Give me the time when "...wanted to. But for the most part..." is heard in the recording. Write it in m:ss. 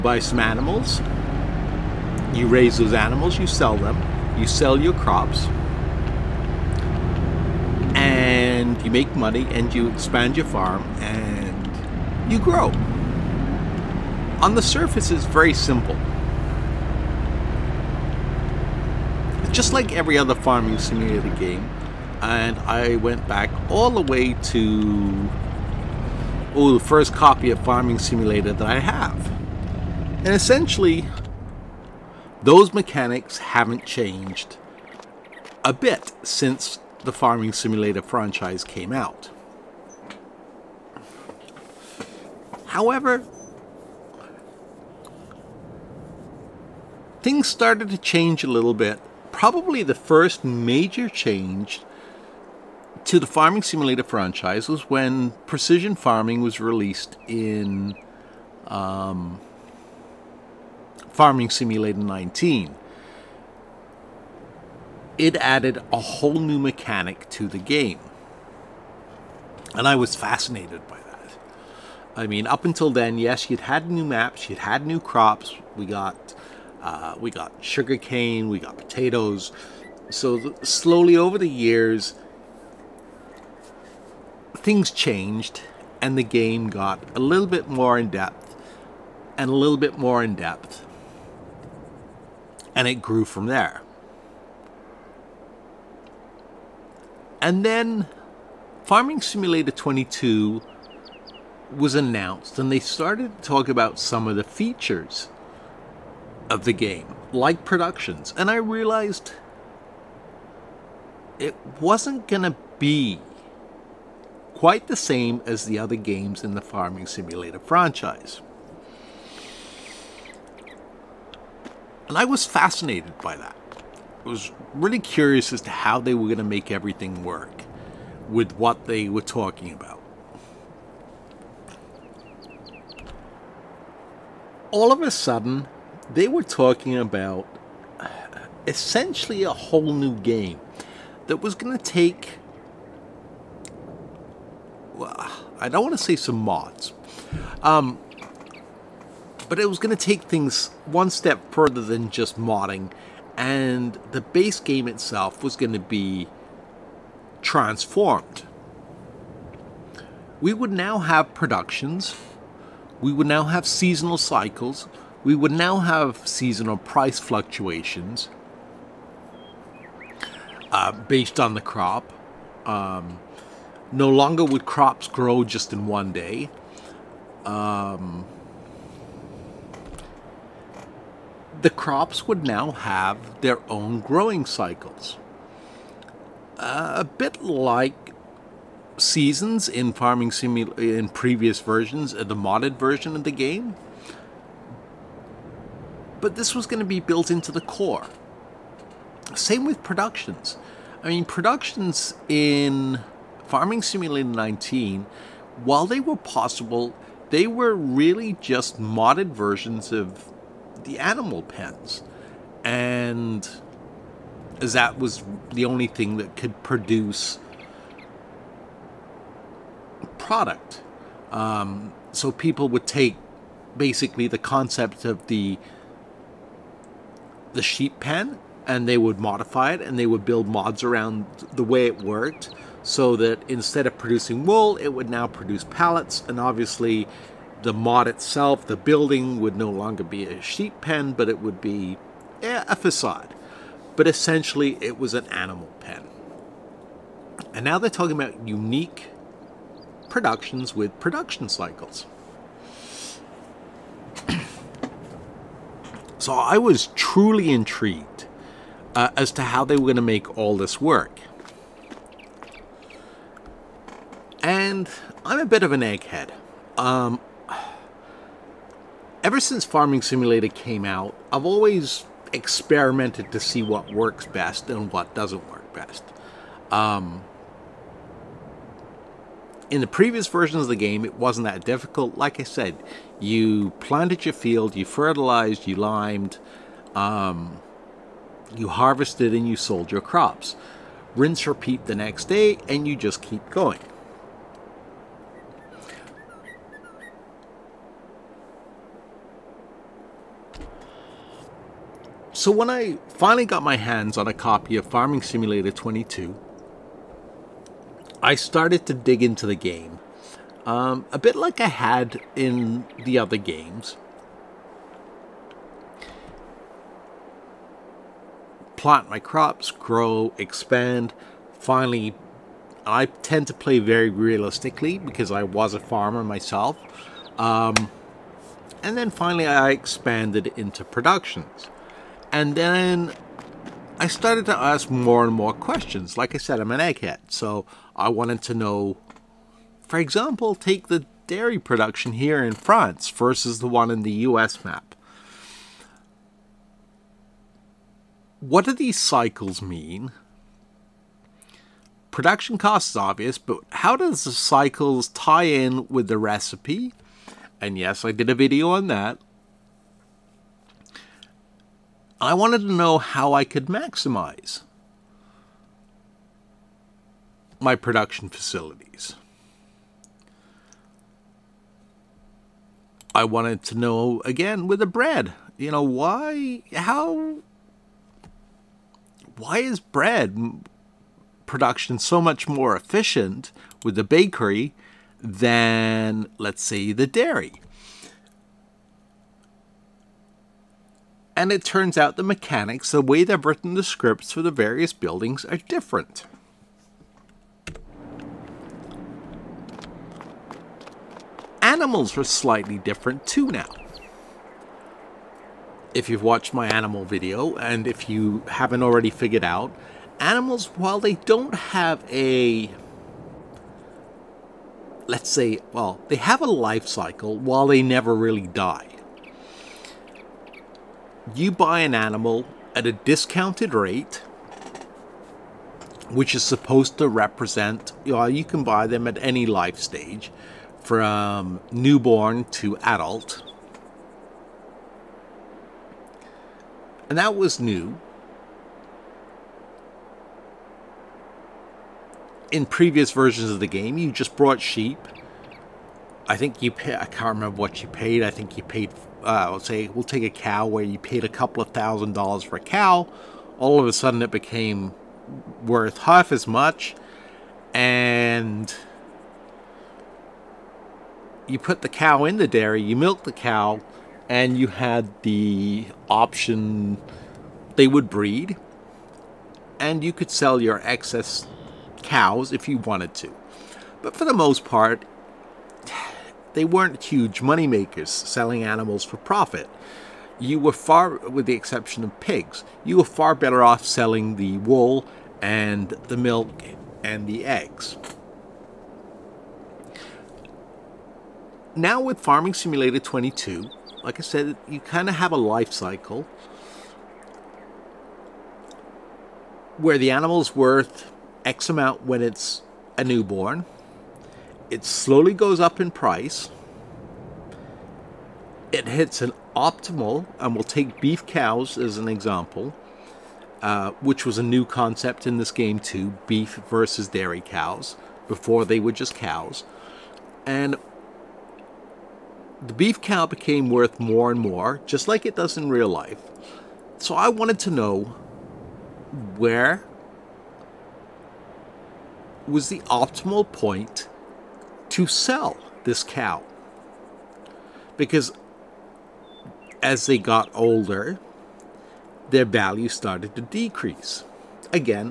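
7:52.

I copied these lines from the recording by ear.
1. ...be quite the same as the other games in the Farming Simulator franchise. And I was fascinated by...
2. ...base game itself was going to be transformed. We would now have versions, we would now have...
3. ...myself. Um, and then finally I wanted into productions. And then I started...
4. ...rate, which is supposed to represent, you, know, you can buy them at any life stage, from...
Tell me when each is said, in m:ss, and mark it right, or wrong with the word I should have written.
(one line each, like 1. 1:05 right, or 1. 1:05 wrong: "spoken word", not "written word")
1. 1:52 right
2. 2:34 wrong: "productions", not "versions"
3. 5:26 wrong: "expanded", not "wanted"
4. 7:03 right.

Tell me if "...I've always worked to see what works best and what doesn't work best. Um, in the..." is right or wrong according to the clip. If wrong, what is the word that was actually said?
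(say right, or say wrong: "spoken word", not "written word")
wrong: "experimented", not "worked".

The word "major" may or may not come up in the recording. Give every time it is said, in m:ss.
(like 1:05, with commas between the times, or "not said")
0:50.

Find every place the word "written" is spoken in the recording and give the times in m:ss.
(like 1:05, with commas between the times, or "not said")
6:33.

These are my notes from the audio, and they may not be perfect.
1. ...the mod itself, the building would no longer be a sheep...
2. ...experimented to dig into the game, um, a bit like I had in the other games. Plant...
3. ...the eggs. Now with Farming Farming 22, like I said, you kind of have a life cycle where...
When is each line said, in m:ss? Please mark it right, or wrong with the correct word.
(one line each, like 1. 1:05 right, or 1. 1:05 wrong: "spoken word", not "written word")
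1. 3:57 right
2. 5:08 wrong: "started", not "experimented"
3. 8:07 wrong: "Simulator", not "Farming".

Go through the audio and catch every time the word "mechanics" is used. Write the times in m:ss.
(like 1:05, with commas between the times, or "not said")
0:32, 1:06, 6:32.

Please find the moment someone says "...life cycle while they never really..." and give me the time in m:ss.
6:56.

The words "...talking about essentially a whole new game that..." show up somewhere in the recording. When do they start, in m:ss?
2:16.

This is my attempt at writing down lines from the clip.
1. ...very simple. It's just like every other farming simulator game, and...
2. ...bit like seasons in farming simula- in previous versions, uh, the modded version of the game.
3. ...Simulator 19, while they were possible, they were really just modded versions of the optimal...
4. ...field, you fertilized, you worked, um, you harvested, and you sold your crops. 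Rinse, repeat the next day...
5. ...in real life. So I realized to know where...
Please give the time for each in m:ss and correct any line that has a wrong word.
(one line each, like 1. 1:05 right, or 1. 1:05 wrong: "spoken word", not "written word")
1. 0:15 right
2. 3:07 right
3. 3:23 wrong: "animal", not "optimal"
4. 4:44 wrong: "limed", not "worked"
5. 8:45 wrong: "wanted", not "realized".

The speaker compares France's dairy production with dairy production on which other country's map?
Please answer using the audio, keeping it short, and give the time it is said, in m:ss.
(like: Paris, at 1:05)
The US, at 5:44.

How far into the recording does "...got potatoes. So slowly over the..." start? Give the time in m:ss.
1:18.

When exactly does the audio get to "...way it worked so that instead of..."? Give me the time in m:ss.
3:51.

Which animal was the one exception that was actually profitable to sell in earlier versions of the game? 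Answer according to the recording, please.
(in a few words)
Pigs.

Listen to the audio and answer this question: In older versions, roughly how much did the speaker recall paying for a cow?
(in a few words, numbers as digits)
A couple of thousand dollars.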